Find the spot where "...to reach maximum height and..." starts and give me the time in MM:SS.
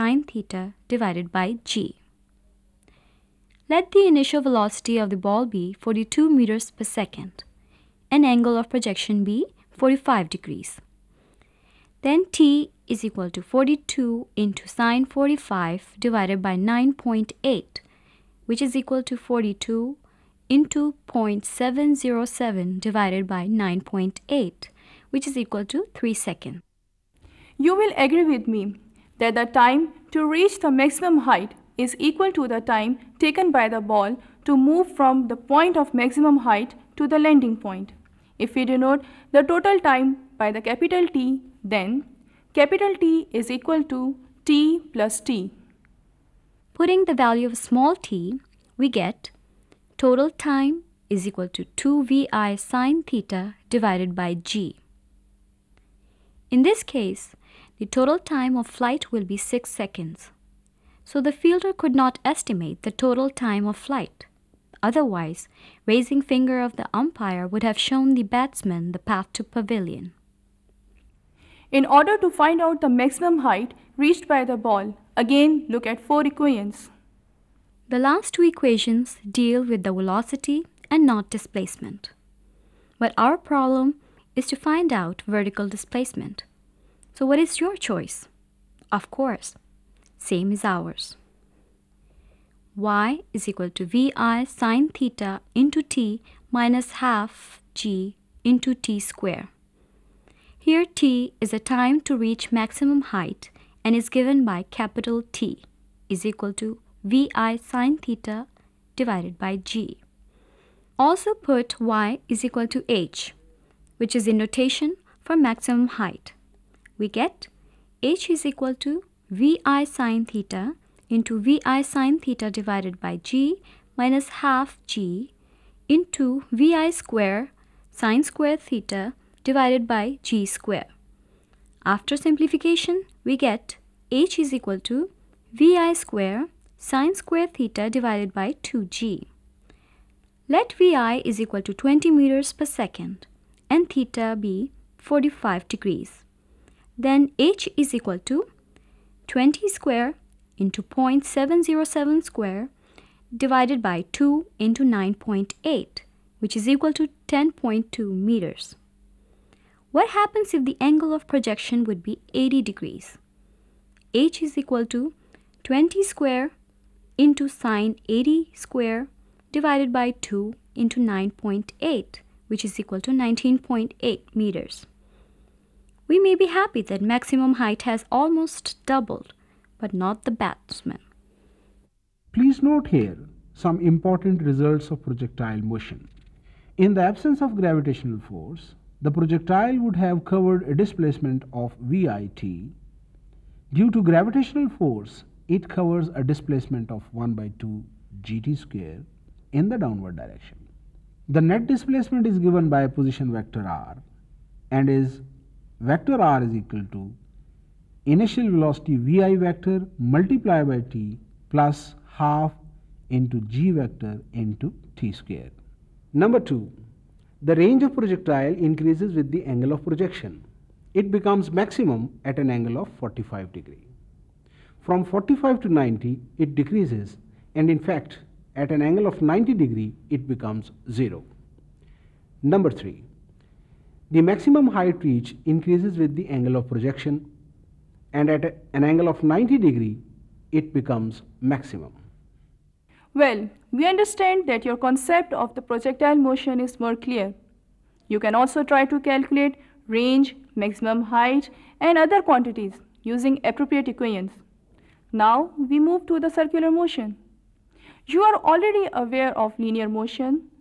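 01:42.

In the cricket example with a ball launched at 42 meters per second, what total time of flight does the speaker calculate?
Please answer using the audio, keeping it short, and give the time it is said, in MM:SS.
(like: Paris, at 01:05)
6 seconds, at 00:59.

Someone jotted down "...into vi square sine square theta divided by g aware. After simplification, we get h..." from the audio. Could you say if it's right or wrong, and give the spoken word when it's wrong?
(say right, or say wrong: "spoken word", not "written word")
wrong: "square", not "aware".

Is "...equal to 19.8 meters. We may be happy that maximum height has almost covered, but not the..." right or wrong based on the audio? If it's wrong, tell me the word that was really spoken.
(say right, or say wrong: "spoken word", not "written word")
wrong: "doubled", not "covered".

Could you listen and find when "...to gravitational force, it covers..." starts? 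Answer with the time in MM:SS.
03:13.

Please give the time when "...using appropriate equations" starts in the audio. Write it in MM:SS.
04:13.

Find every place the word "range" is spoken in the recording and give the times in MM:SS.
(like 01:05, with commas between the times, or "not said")
03:37, 04:09.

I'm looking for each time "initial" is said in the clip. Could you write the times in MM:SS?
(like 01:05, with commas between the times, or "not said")
00:04, 03:28.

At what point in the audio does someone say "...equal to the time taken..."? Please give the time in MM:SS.
00:31.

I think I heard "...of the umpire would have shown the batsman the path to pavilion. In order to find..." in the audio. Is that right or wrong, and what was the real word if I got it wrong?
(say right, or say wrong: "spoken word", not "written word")
right.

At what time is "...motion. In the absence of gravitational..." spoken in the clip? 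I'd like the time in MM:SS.
03:05.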